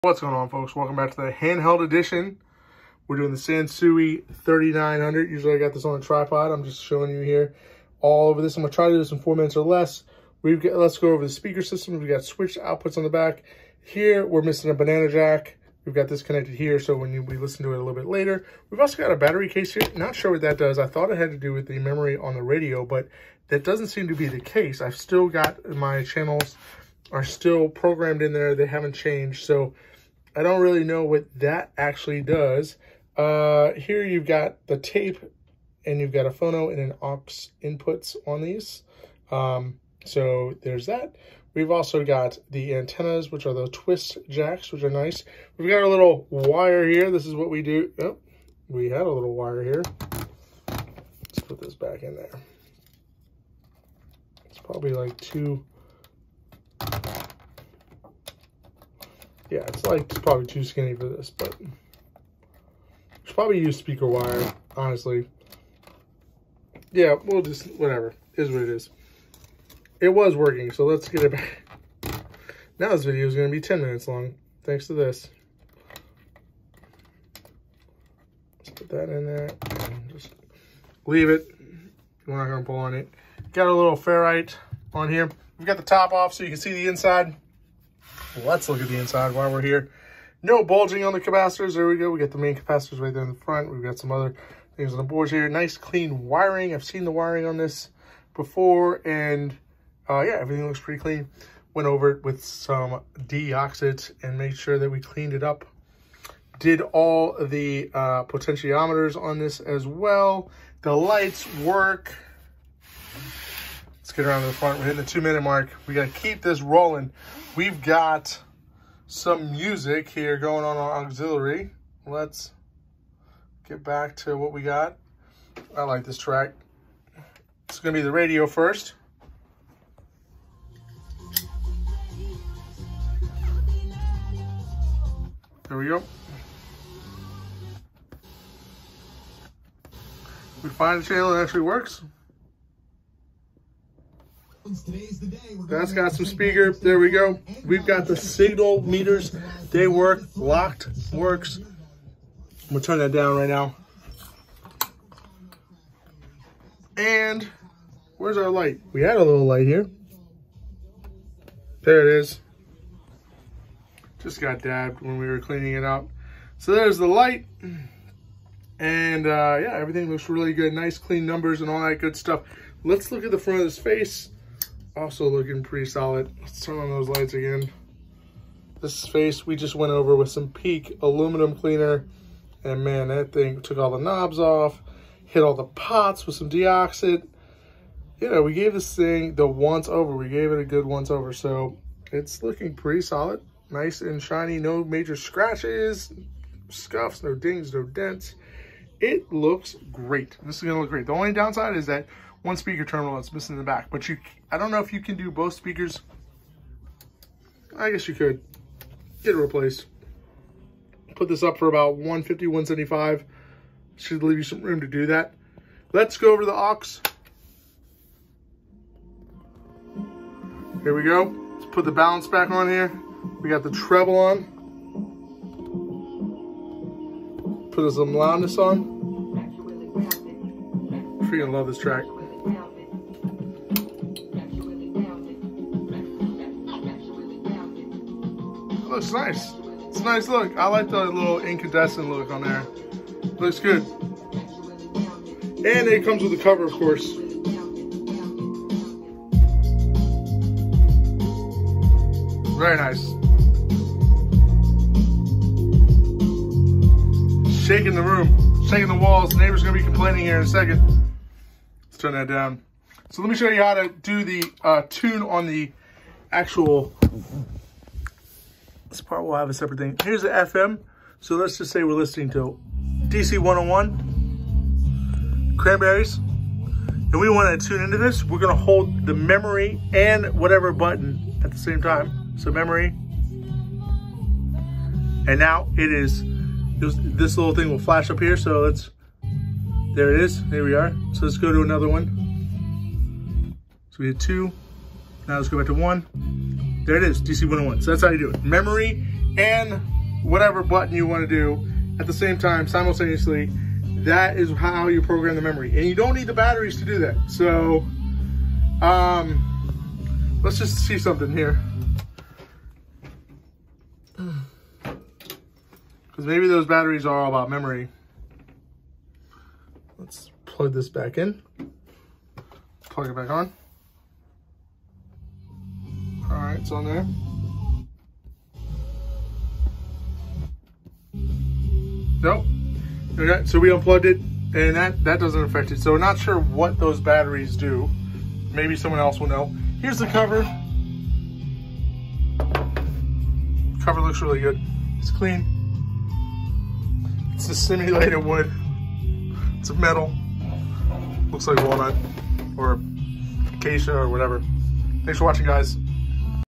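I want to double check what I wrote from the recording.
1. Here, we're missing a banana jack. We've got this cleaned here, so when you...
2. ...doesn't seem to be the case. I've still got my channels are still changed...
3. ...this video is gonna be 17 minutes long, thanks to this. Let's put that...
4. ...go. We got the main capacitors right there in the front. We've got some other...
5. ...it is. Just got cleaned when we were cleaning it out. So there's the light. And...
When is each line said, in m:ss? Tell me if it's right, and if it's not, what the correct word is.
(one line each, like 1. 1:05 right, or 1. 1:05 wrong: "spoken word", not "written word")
1. 0:13 wrong: "connected", not "cleaned"
2. 0:23 wrong: "programmed", not "changed"
3. 1:12 wrong: "10", not "17"
4. 1:31 right
5. 2:42 wrong: "dabbed", not "cleaned".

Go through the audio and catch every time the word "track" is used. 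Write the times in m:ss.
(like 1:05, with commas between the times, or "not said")
2:06, 3:51.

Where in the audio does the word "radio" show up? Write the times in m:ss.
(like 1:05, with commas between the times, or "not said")
0:22, 2:08.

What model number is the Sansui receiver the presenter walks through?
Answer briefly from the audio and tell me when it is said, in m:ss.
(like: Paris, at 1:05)
3900, at 0:04.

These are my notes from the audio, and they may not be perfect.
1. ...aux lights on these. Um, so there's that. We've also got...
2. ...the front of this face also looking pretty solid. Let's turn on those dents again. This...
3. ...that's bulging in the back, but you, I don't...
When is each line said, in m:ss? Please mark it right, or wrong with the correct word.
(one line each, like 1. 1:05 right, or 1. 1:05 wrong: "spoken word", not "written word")
1. 0:37 wrong: "inputs", not "lights"
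2. 2:53 wrong: "lights", not "dents"
3. 3:23 wrong: "missing", not "bulging".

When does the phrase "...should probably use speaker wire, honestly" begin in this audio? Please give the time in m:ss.
1:03.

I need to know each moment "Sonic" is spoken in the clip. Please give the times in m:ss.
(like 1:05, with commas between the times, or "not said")
not said.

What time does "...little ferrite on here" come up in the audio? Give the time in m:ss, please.
1:23.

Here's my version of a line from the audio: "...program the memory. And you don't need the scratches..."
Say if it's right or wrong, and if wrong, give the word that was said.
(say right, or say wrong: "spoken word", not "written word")
wrong: "batteries", not "scratches".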